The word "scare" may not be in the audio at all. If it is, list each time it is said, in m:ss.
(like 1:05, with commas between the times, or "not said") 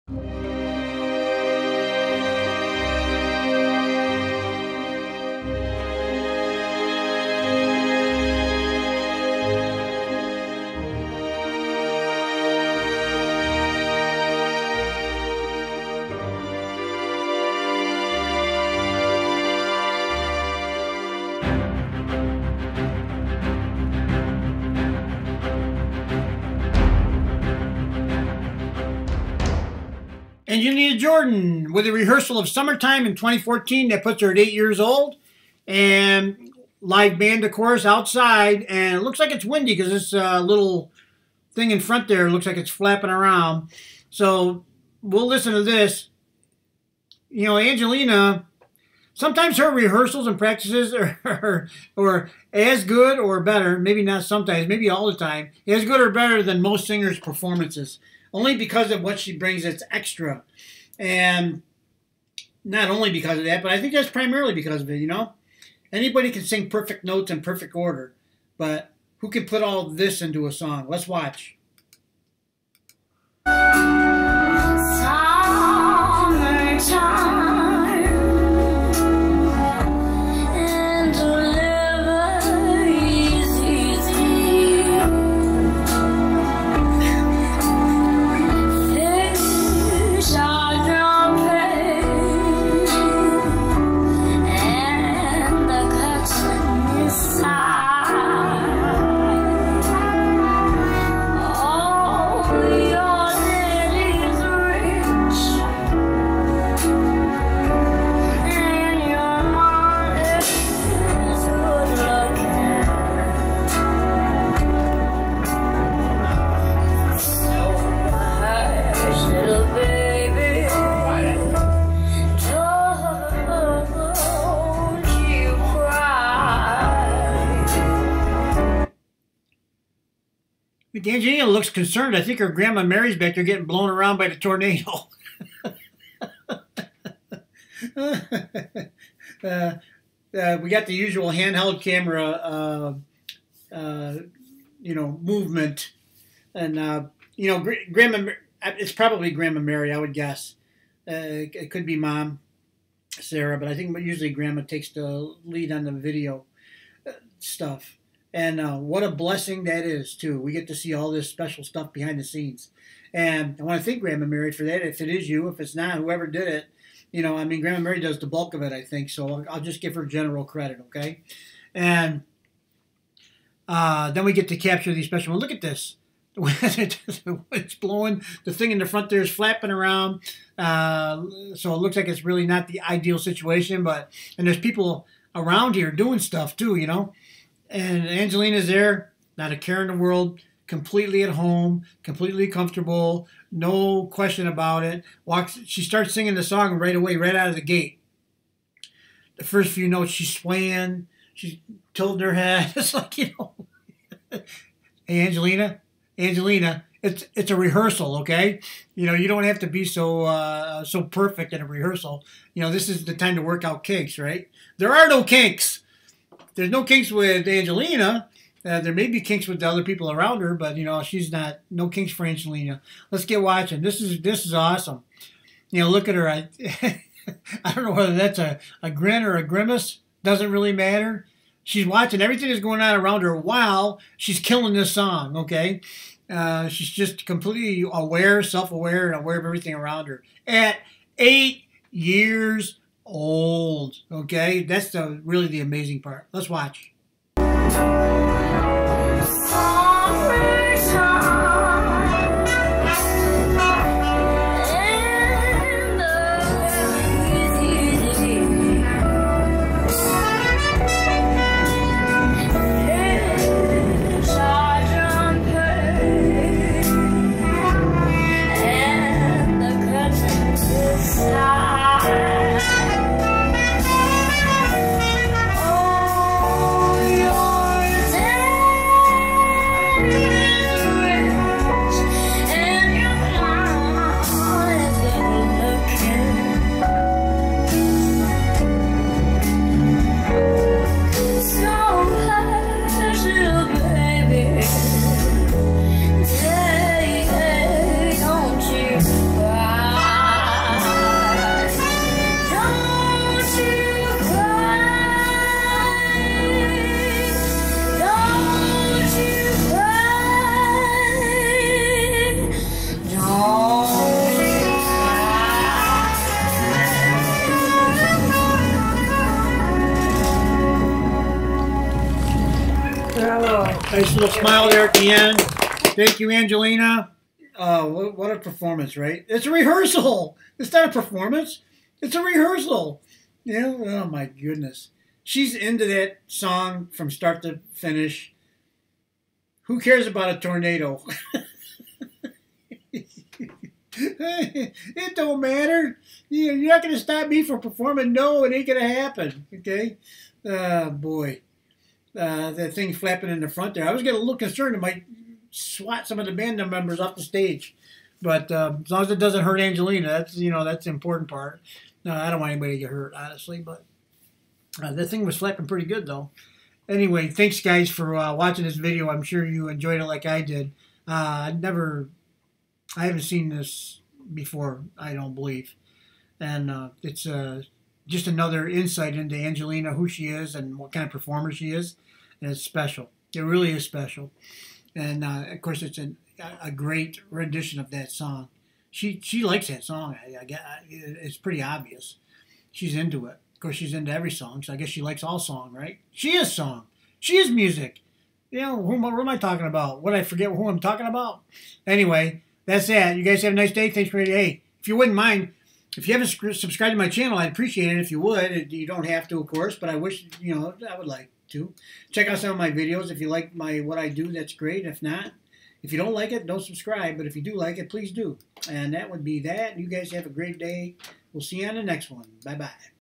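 not said.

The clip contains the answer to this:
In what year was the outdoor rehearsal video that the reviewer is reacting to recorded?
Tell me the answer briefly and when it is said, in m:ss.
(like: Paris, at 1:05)
2014, at 0:33.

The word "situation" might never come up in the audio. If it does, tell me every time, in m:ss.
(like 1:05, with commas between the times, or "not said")
3:03.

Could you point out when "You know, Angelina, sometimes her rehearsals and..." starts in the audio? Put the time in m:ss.
0:47.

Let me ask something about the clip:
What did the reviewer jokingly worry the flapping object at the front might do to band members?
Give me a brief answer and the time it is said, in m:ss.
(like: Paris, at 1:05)
Swat, at 5:55.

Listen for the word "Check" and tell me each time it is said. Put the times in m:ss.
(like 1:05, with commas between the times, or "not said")
6:52.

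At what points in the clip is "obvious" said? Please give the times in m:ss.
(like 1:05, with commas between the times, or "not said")
6:31.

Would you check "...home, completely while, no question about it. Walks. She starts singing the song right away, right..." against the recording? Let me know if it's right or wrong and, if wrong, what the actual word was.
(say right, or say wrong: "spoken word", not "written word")
wrong: "comfortable", not "while".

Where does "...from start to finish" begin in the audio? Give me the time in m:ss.
5:36.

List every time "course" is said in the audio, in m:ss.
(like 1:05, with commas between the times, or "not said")
0:37, 6:25, 6:33, 6:49.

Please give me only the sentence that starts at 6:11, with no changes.
Uh, I never, I haven't seen this before.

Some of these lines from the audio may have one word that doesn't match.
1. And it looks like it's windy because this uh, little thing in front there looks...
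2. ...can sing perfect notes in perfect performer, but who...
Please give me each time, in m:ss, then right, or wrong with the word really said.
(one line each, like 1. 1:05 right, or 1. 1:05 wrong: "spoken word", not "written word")
1. 0:38 right
2. 1:06 wrong: "order", not "performer".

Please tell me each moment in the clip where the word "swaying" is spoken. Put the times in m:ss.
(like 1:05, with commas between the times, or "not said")
3:20.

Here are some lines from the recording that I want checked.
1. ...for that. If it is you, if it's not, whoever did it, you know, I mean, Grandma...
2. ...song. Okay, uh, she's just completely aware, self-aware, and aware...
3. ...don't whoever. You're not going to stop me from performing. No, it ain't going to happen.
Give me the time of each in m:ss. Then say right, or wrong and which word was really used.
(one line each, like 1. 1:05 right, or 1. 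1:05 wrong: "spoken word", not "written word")
1. 2:44 right
2. 3:54 right
3. 5:45 wrong: "matter", not "whoever".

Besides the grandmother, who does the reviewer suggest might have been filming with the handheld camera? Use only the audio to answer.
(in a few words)
Sarah.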